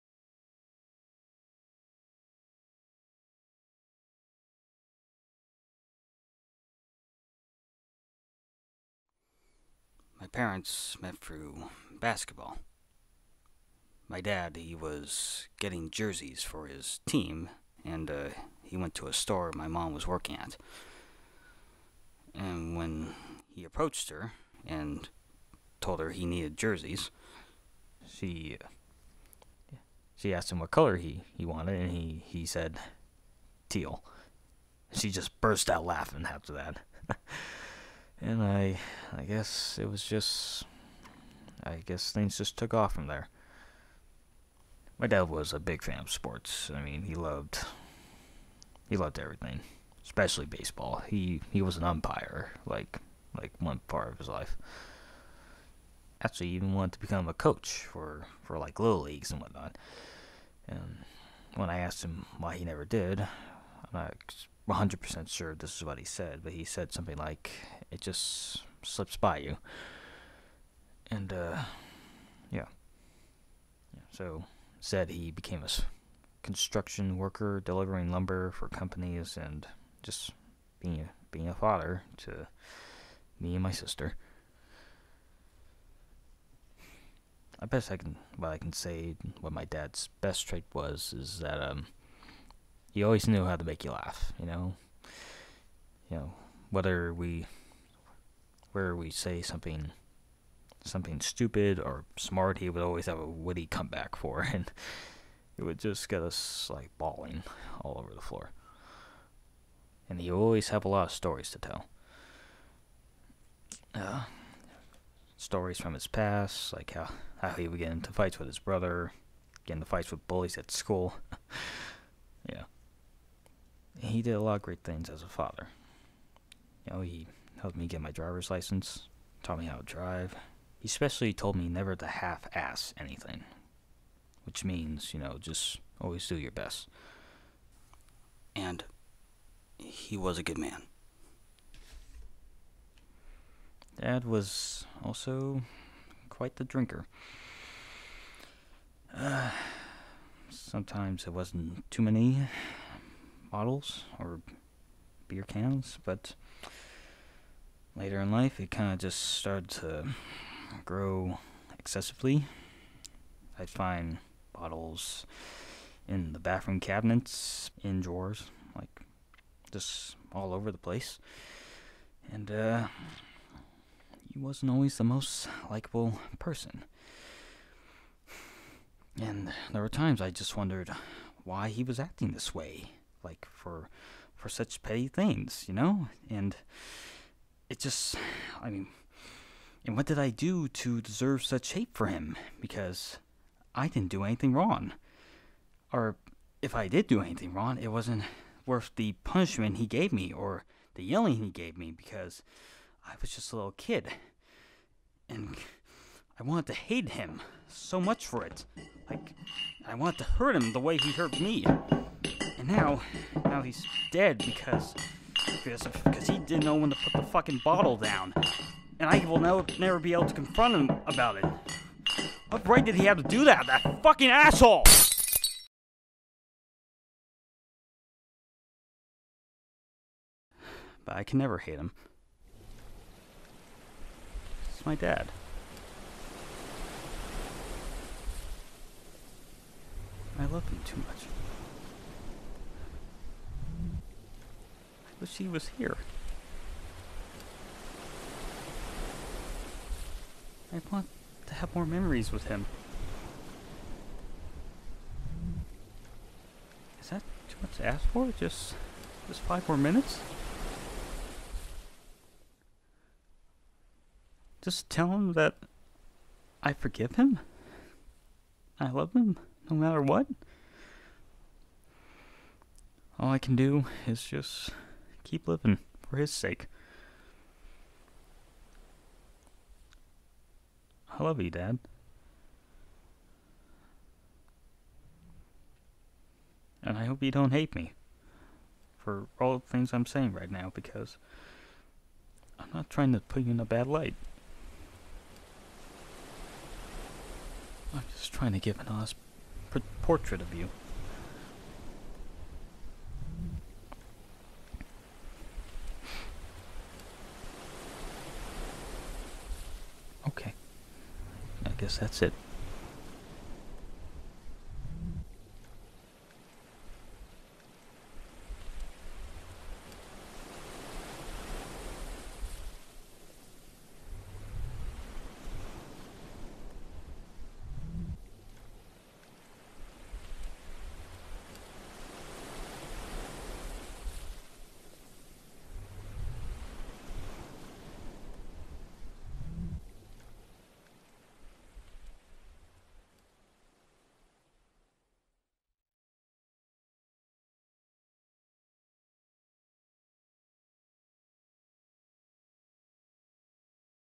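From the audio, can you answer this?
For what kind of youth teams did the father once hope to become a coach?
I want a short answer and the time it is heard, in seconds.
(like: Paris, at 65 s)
little leagues, at 58 s.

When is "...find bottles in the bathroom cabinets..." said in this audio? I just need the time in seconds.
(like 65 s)
163 s.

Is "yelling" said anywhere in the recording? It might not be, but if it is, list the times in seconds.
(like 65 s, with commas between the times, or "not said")
201 s.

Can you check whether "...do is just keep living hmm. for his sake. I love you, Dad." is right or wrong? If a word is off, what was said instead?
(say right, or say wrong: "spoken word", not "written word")
right.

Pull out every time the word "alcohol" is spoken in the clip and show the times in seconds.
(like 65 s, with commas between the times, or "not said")
not said.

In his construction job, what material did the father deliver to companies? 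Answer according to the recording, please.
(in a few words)
lumber.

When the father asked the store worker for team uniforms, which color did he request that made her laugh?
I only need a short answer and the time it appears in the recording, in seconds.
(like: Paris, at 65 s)
teal, at 33 s.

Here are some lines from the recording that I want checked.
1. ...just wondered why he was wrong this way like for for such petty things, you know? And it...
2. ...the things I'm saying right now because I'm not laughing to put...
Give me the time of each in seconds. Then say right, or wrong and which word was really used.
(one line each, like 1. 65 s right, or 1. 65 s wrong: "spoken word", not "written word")
1. 180 s wrong: "acting", not "wrong"
2. 289 s wrong: "trying", not "laughing".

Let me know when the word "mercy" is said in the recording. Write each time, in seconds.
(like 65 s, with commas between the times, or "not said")
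not said.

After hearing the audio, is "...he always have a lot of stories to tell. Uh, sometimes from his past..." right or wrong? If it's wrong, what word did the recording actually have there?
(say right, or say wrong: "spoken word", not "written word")
wrong: "stories", not "sometimes".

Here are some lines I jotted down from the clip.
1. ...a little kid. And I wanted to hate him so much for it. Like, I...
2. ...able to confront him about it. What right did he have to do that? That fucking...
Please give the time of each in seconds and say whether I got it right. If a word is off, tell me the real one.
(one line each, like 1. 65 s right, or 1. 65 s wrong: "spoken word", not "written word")
1. 203 s right
2. 220 s right.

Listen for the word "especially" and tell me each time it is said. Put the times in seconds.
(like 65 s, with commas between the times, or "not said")
50 s, 130 s.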